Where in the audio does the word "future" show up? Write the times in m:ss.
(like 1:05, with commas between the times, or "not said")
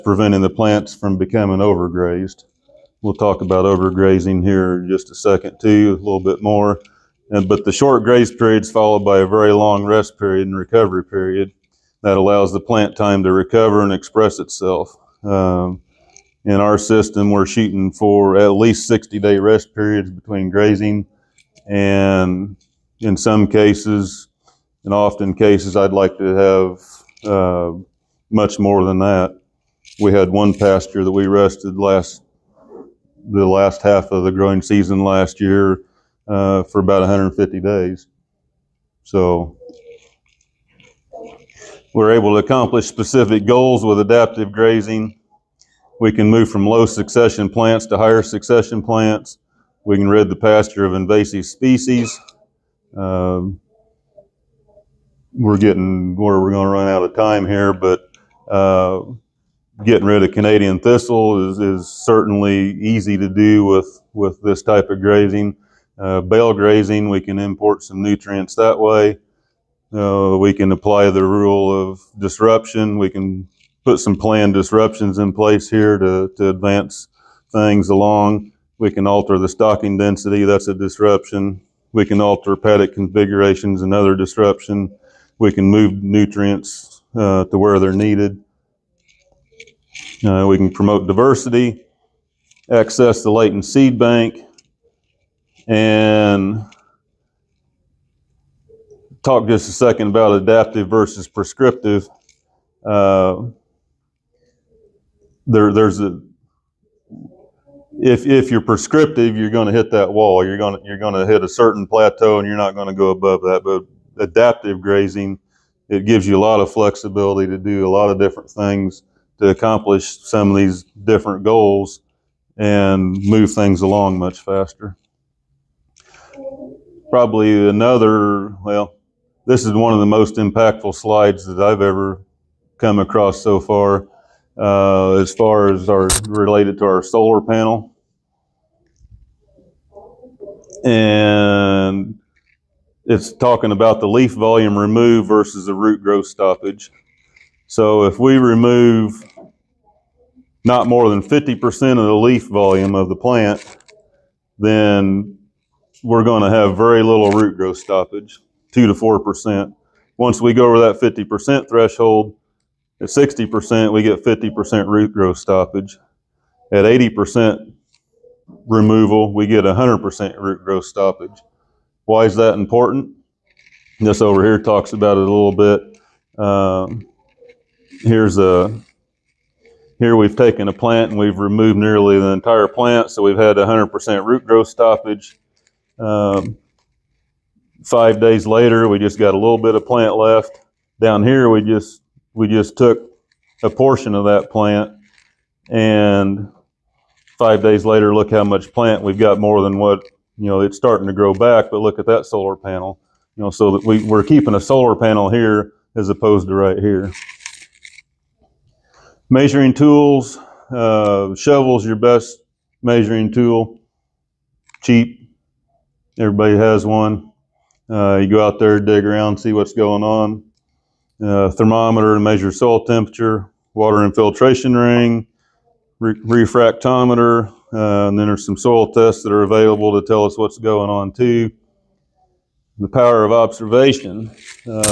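not said.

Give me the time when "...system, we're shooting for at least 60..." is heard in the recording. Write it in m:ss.
0:16.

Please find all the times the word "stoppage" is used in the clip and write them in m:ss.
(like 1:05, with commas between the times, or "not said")
2:26, 2:37, 2:45, 2:50, 3:04.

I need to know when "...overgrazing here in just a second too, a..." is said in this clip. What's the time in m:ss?
0:03.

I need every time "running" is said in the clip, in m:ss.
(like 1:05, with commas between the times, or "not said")
not said.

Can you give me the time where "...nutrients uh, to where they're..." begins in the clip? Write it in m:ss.
1:26.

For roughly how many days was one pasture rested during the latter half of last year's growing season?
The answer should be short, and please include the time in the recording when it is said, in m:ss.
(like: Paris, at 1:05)
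150 days, at 0:37.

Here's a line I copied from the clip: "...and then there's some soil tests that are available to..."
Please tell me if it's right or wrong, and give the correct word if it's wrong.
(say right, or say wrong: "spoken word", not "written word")
right.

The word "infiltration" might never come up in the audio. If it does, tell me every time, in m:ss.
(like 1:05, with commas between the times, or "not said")
3:44.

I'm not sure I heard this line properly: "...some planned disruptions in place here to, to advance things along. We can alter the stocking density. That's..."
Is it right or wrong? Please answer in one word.
right.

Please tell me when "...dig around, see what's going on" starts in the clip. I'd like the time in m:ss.
3:38.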